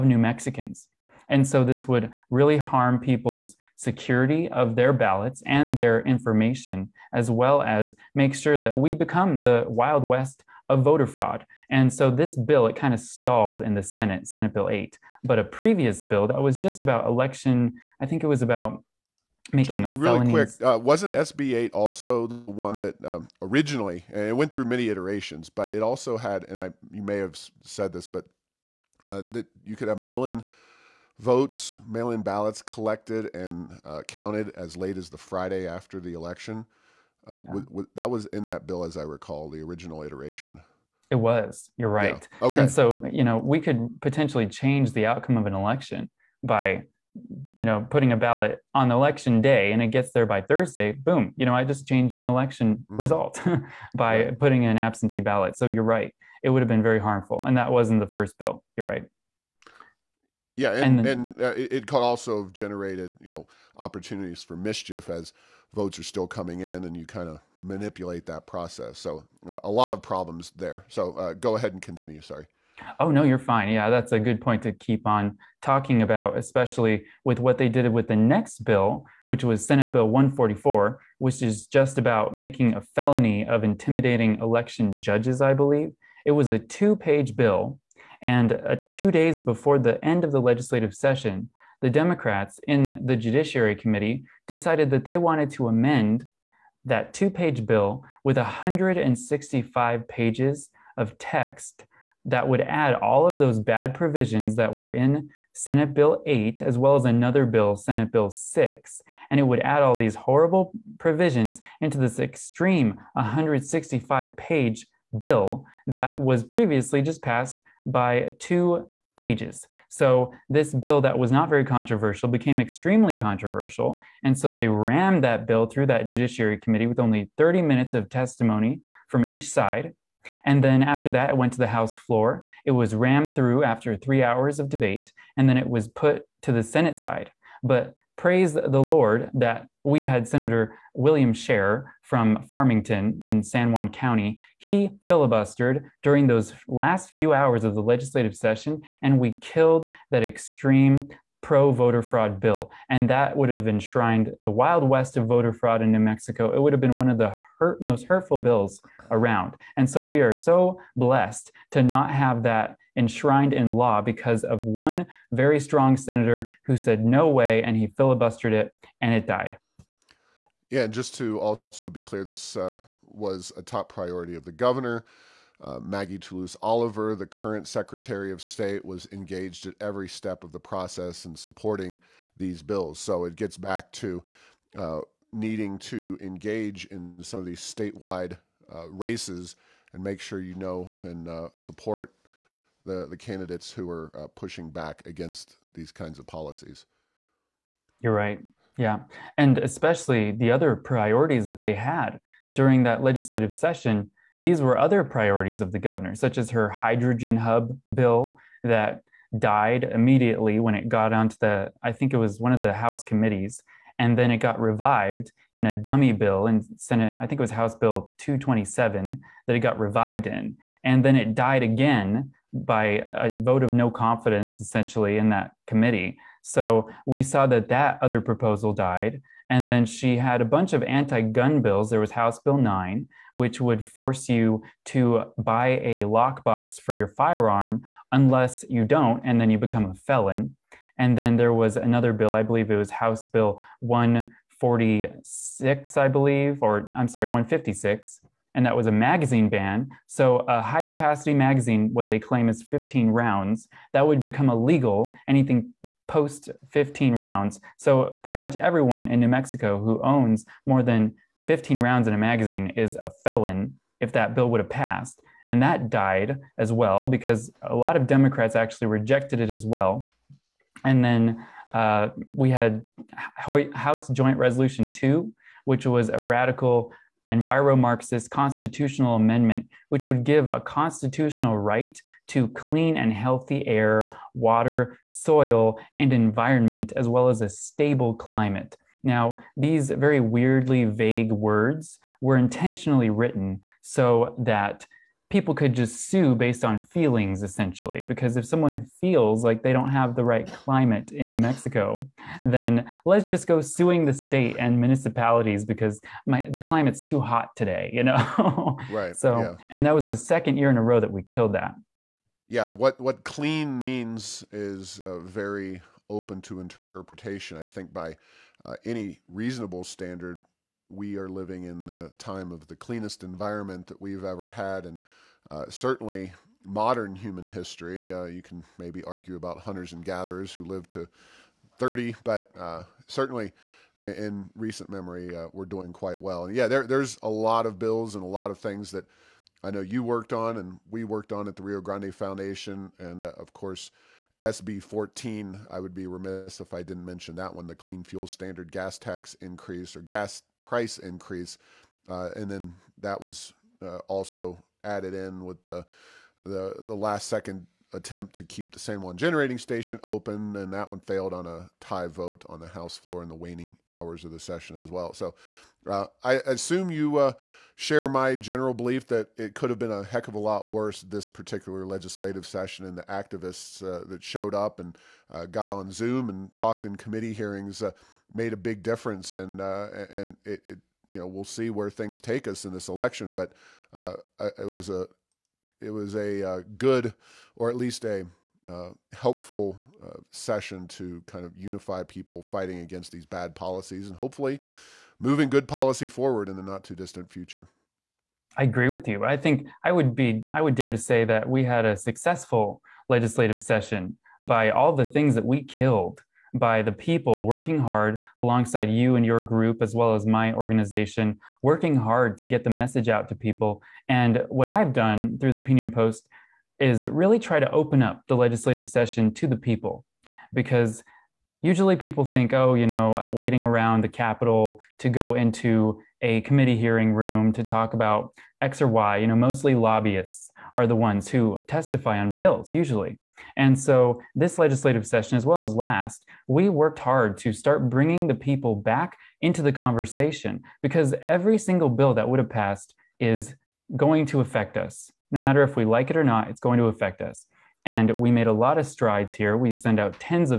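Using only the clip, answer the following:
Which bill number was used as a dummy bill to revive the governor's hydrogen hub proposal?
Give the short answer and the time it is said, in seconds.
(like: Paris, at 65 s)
House Bill 227, at 217 s.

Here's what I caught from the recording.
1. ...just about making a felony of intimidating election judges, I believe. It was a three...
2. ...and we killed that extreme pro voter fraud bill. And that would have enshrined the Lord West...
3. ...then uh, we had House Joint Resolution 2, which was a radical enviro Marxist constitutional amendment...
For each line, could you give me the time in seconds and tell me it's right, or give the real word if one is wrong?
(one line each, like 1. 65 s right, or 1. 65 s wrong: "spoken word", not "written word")
1. 81 s wrong: "two", not "three"
2. 149 s wrong: "Wild", not "Lord"
3. 271 s right.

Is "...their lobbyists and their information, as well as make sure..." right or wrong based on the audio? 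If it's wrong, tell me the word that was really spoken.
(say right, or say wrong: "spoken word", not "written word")
wrong: "ballots", not "lobbyists".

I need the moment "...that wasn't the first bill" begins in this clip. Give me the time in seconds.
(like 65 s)
57 s.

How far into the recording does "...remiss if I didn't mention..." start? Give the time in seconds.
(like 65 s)
346 s.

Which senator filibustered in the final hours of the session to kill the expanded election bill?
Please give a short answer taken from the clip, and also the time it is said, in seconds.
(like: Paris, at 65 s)
William Sharer, at 140 s.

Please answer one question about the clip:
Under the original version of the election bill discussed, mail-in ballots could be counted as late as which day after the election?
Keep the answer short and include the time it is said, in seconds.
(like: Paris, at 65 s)
Friday, at 35 s.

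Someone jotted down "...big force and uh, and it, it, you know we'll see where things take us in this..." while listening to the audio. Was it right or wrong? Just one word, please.
wrong.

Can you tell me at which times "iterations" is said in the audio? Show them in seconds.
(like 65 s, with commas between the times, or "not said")
24 s, 40 s.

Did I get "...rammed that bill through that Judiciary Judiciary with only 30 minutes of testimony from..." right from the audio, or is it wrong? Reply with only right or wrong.
wrong.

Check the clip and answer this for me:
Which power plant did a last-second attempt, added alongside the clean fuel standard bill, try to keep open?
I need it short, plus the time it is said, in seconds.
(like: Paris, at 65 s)
San Juan generating station, at 358 s.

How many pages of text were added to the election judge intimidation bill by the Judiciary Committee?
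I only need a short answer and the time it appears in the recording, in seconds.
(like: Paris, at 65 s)
165, at 98 s.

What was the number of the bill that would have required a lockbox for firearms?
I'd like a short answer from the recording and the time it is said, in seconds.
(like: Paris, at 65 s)
House Bill 9, at 232 s.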